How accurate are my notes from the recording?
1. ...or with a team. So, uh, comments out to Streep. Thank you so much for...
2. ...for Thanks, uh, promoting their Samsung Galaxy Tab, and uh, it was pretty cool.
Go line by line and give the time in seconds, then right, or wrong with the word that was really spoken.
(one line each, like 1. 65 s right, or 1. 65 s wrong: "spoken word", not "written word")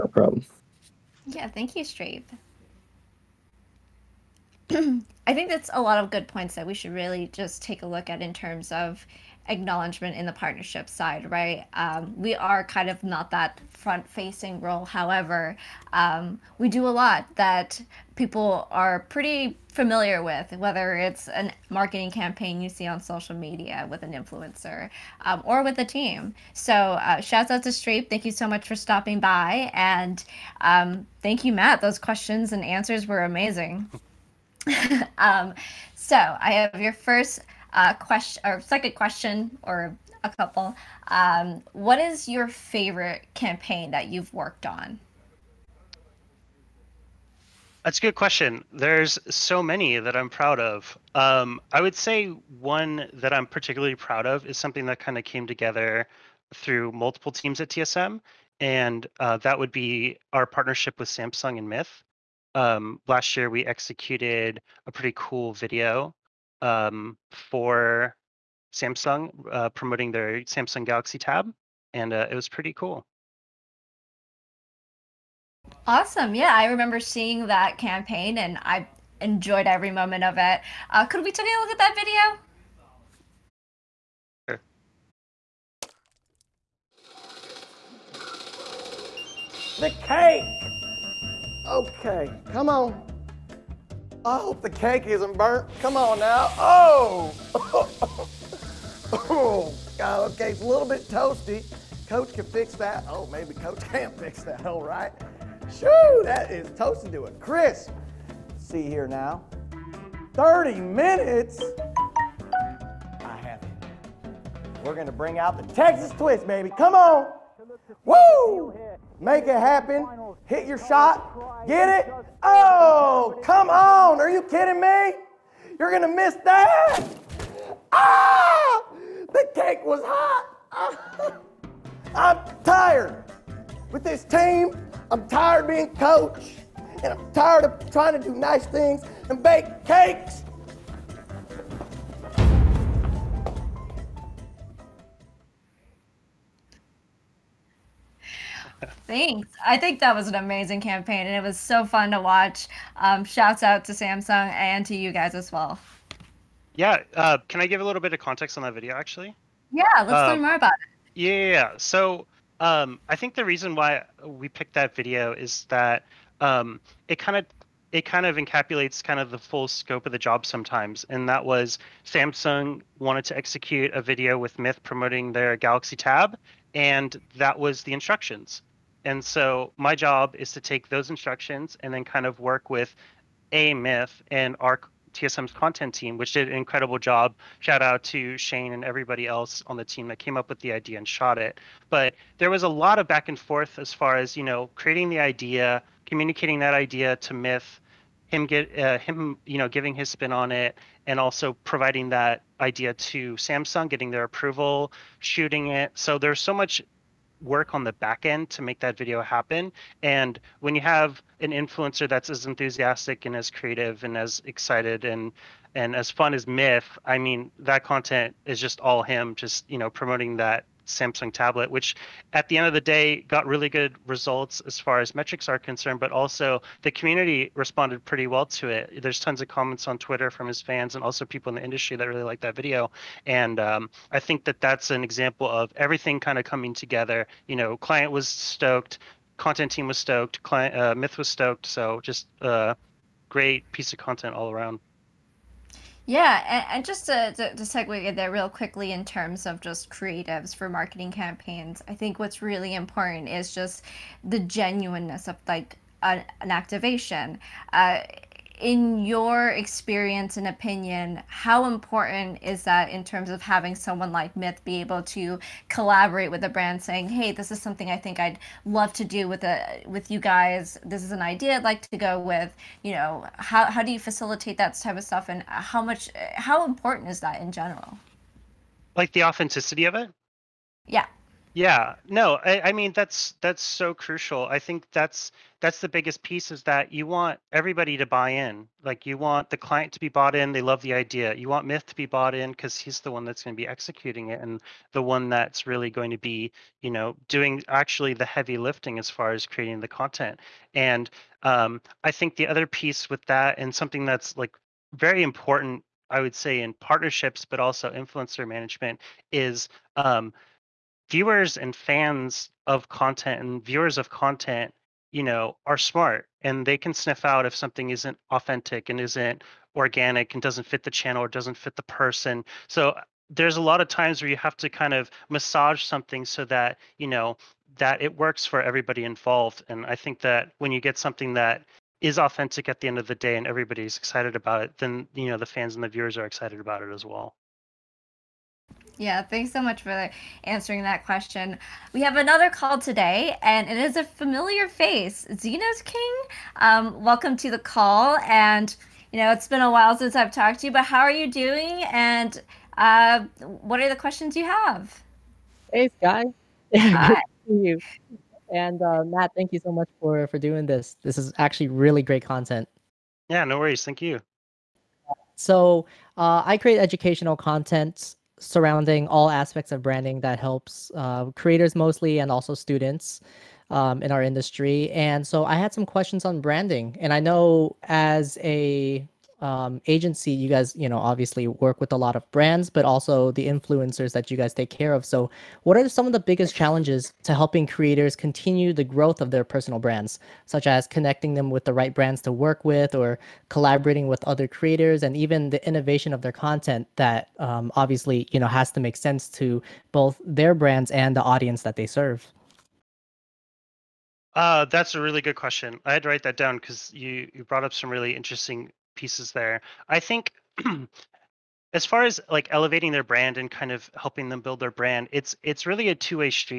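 1. 25 s wrong: "shouts", not "comments"
2. 67 s wrong: "Samsung", not "Thanks".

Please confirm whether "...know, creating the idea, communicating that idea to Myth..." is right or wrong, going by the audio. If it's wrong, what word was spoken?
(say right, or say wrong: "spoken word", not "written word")
right.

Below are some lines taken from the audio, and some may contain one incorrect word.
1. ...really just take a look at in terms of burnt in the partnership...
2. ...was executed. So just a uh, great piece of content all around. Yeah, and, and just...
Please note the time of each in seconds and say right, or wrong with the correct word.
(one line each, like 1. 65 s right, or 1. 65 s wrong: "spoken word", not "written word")
1. 6 s wrong: "acknowledgement", not "burnt"
2. 241 s wrong: "stoked", not "executed".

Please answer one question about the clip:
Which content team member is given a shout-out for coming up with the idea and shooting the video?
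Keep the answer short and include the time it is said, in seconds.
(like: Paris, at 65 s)
Shane, at 187 s.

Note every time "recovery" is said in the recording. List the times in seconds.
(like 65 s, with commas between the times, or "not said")
not said.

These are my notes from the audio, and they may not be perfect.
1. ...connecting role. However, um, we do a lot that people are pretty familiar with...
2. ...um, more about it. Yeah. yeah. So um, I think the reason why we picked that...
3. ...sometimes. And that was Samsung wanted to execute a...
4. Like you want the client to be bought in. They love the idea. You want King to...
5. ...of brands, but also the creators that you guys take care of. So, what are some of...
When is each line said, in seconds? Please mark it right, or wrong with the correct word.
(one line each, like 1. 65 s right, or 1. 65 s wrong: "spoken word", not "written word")
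1. 14 s wrong: "facing", not "connecting"
2. 160 s right
3. 170 s right
4. 288 s wrong: "Myth", not "King"
5. 382 s wrong: "influencers", not "creators".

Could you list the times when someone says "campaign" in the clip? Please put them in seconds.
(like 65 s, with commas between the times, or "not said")
22 s, 43 s, 77 s, 150 s, 251 s.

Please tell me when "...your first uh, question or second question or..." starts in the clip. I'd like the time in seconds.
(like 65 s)
36 s.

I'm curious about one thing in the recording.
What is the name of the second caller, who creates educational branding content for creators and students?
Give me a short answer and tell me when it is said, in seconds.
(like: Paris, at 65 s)
Zeno's King, at 345 s.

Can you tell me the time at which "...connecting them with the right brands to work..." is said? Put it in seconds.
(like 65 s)
390 s.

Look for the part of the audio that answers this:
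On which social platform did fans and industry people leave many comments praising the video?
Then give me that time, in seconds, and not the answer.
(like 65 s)
229 s.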